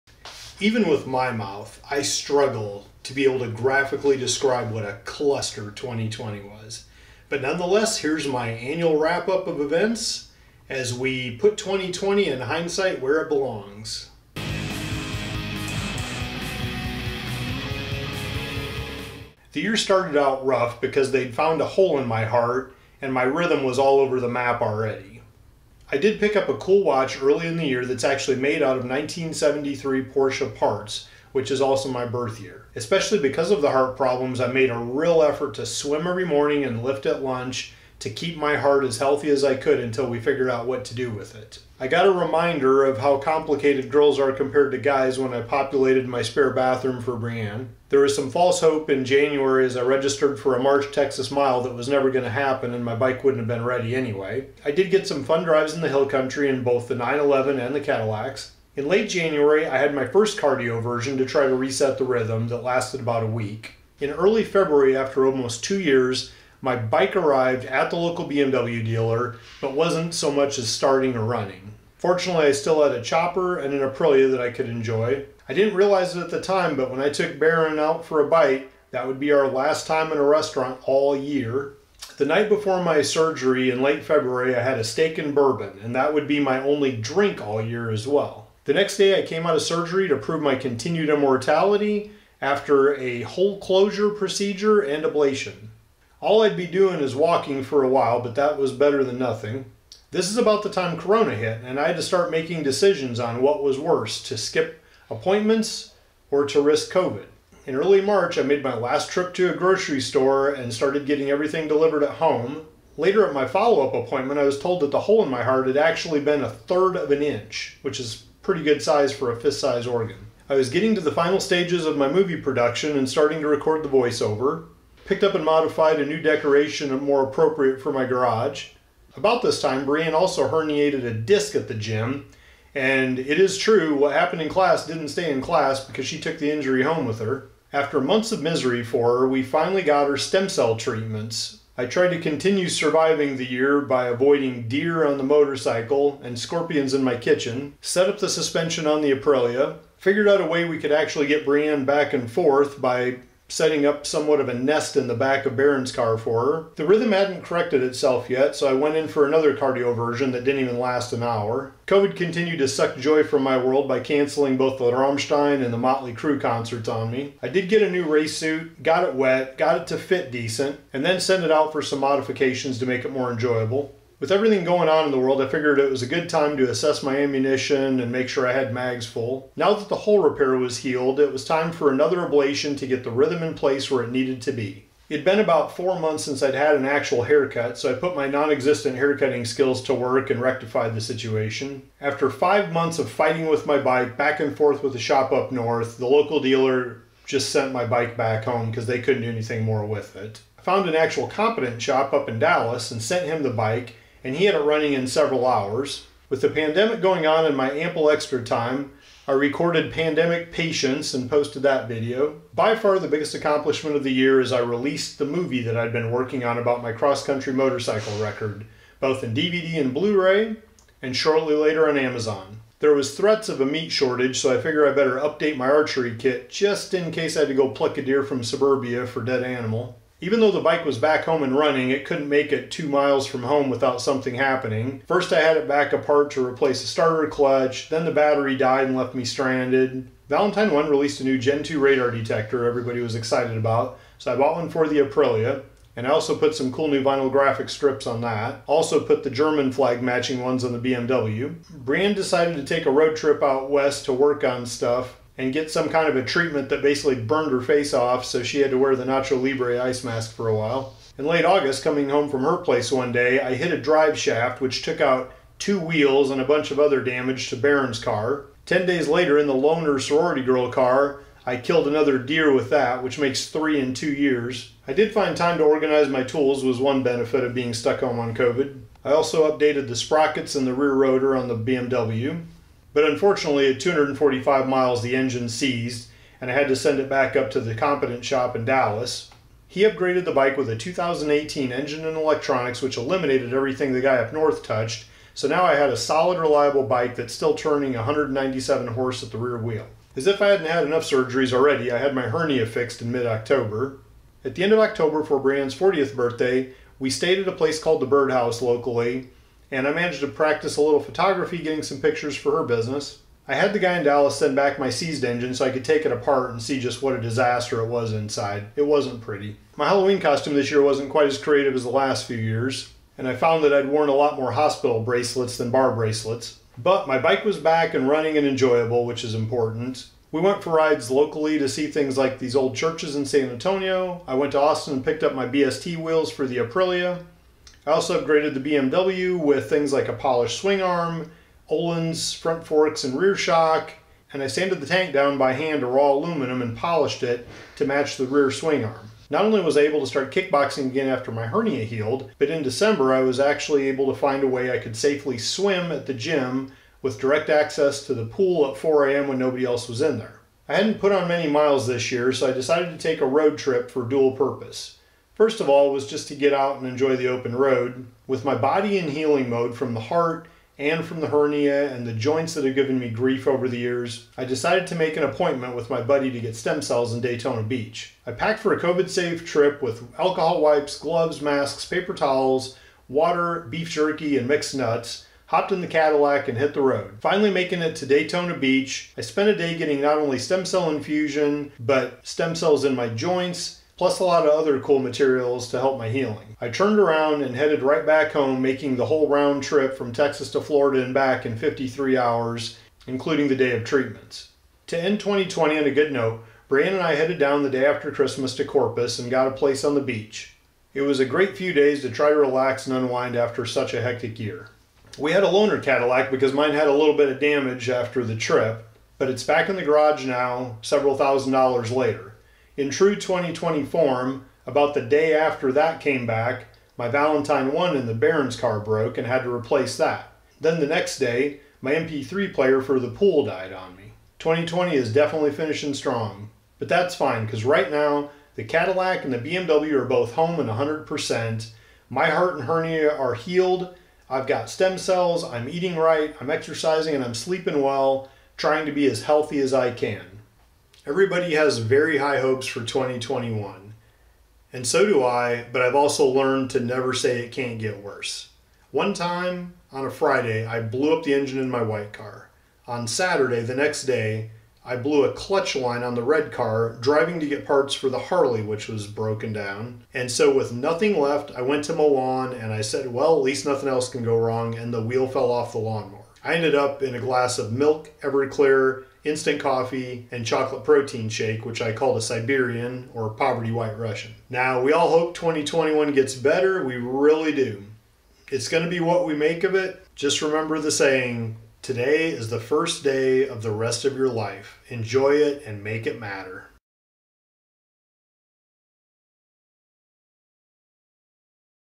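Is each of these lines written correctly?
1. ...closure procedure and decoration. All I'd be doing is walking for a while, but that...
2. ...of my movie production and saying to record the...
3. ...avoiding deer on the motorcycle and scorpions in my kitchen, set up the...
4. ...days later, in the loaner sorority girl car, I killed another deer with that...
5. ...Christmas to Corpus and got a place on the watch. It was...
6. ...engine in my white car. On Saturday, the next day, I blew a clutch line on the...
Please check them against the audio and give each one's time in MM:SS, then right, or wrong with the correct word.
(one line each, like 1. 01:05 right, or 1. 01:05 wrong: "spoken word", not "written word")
1. 01:33 wrong: "ablation", not "decoration"
2. 02:01 wrong: "starting", not "saying"
3. 02:24 right
4. 04:28 right
5. 06:48 wrong: "beach", not "watch"
6. 07:41 right.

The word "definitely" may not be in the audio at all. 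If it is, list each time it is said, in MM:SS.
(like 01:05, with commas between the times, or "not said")
07:15.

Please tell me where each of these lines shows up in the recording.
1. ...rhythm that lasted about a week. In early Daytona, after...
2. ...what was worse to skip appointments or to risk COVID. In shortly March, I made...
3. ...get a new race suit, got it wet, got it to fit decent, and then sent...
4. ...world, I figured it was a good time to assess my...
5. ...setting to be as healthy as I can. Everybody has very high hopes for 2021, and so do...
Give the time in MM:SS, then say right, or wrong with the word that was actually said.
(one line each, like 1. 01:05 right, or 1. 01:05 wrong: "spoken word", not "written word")
1. 01:02 wrong: "February", not "Daytona"
2. 01:43 wrong: "early", not "shortly"
3. 02:47 right
4. 02:55 right
5. 07:28 wrong: "trying", not "setting".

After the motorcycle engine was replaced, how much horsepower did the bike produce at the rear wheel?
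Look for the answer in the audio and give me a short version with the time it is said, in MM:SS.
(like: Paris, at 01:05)
197, at 04:57.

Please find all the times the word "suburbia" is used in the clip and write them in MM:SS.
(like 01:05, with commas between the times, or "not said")
03:48.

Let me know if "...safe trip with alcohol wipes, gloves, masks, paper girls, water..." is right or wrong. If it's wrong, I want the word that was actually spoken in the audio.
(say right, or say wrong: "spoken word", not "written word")
wrong: "towels", not "girls".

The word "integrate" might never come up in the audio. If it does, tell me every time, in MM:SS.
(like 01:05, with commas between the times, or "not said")
not said.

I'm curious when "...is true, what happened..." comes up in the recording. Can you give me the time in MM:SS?
02:13.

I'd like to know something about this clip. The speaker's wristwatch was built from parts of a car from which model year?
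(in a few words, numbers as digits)
1973.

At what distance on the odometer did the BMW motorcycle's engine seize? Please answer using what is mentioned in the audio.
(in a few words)
245 miles.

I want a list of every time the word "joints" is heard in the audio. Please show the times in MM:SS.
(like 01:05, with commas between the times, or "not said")
06:12, 06:33.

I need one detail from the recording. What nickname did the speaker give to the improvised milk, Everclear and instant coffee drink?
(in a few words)
poverty white Russian.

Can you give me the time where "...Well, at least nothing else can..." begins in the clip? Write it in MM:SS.
07:53.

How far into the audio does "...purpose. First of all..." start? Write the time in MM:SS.
06:04.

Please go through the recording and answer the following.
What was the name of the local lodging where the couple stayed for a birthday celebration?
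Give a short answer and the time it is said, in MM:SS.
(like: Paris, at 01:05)
the Birdhouse, at 05:08.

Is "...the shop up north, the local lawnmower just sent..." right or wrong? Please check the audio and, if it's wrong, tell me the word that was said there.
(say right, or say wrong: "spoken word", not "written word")
wrong: "dealer", not "lawnmower".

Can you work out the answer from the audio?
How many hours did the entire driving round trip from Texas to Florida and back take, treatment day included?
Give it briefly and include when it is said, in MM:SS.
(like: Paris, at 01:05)
53, at 06:41.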